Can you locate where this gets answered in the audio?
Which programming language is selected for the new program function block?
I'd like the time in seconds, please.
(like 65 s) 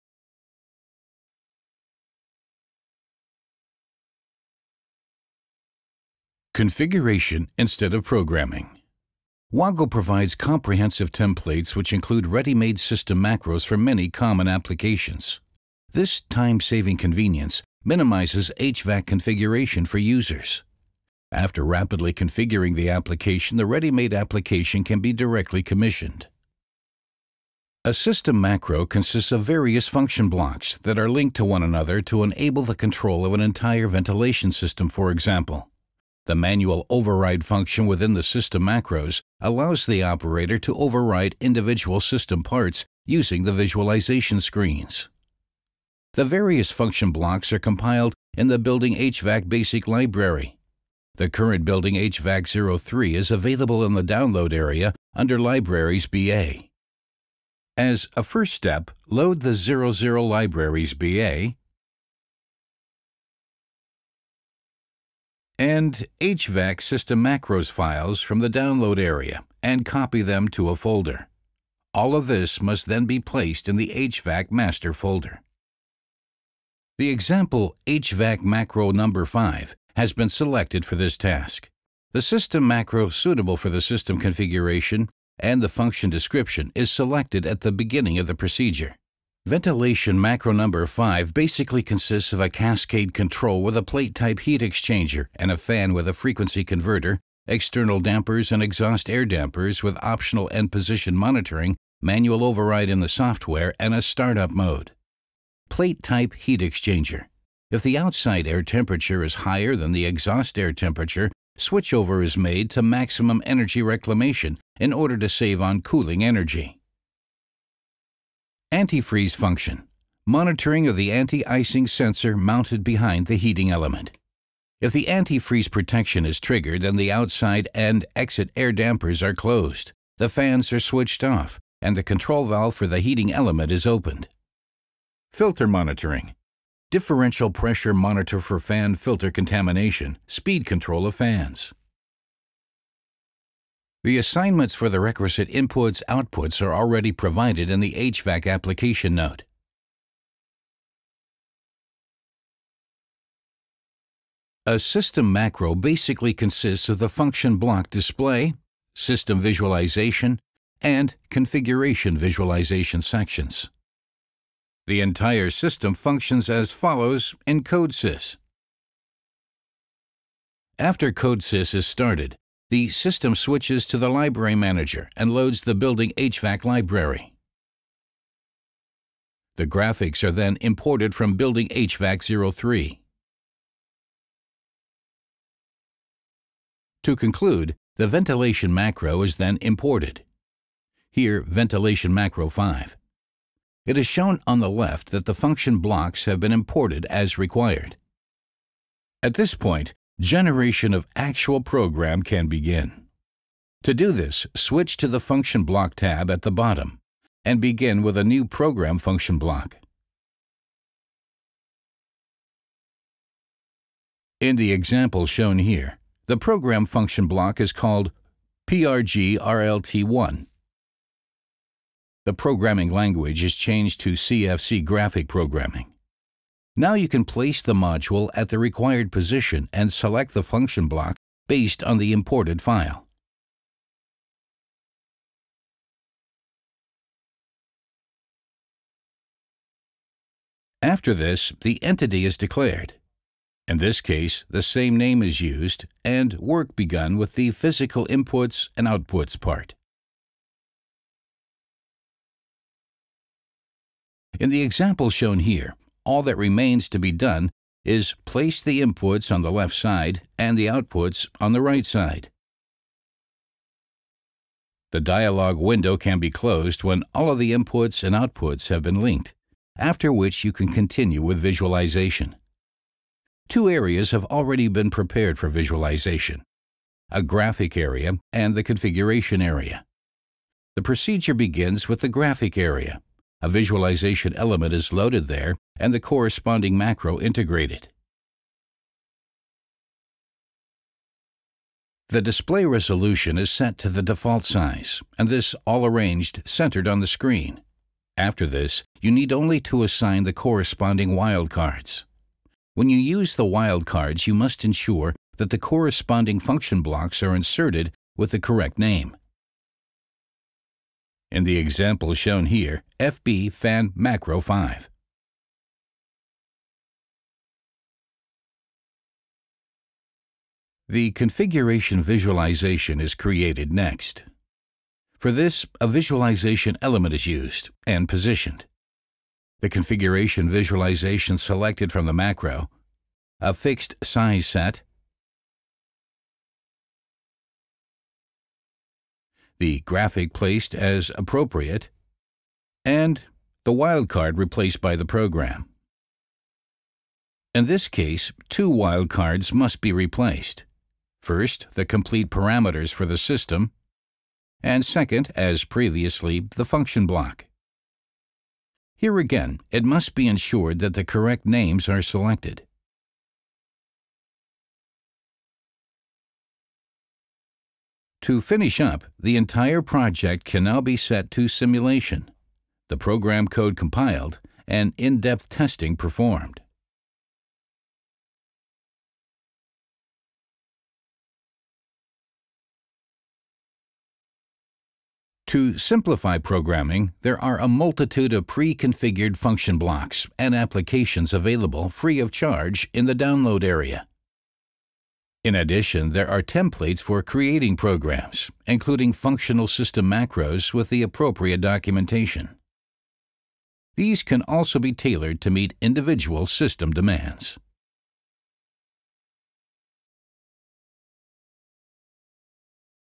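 224 s.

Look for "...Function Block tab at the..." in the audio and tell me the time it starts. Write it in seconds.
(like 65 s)
205 s.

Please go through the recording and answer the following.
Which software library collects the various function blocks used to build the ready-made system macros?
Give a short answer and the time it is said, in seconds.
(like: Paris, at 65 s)
Building HVAC Basic Library, at 48 s.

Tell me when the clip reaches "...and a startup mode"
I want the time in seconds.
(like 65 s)
103 s.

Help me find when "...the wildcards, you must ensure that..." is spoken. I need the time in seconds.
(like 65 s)
303 s.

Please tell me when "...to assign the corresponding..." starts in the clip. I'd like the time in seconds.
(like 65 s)
299 s.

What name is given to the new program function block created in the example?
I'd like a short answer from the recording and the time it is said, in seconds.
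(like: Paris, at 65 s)
PRGRLT1, at 218 s.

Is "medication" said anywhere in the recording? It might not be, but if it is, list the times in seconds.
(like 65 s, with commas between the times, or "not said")
not said.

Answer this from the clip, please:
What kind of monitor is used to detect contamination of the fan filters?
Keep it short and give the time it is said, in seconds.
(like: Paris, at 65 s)
Differential pressure monitor, at 136 s.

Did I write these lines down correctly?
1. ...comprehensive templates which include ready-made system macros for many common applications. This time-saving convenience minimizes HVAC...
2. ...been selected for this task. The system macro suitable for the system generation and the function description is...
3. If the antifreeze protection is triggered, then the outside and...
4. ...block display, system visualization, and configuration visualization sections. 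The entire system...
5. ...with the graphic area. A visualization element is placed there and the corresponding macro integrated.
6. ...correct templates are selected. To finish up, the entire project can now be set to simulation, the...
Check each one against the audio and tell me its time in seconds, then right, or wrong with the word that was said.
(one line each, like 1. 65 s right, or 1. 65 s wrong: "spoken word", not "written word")
1. 10 s right
2. 80 s wrong: "configuration", not "generation"
3. 124 s right
4. 157 s right
5. 281 s wrong: "loaded", not "placed"
6. 361 s wrong: "names", not "templates".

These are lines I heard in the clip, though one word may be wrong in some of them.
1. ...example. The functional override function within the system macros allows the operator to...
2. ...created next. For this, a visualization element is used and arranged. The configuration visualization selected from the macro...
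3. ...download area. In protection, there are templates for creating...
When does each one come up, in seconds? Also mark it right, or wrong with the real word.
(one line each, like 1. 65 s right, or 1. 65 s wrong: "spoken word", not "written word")
1. 35 s wrong: "manual", not "functional"
2. 323 s wrong: "positioned", not "arranged"
3. 393 s wrong: "addition", not "protection".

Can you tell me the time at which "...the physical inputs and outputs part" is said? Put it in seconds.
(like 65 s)
247 s.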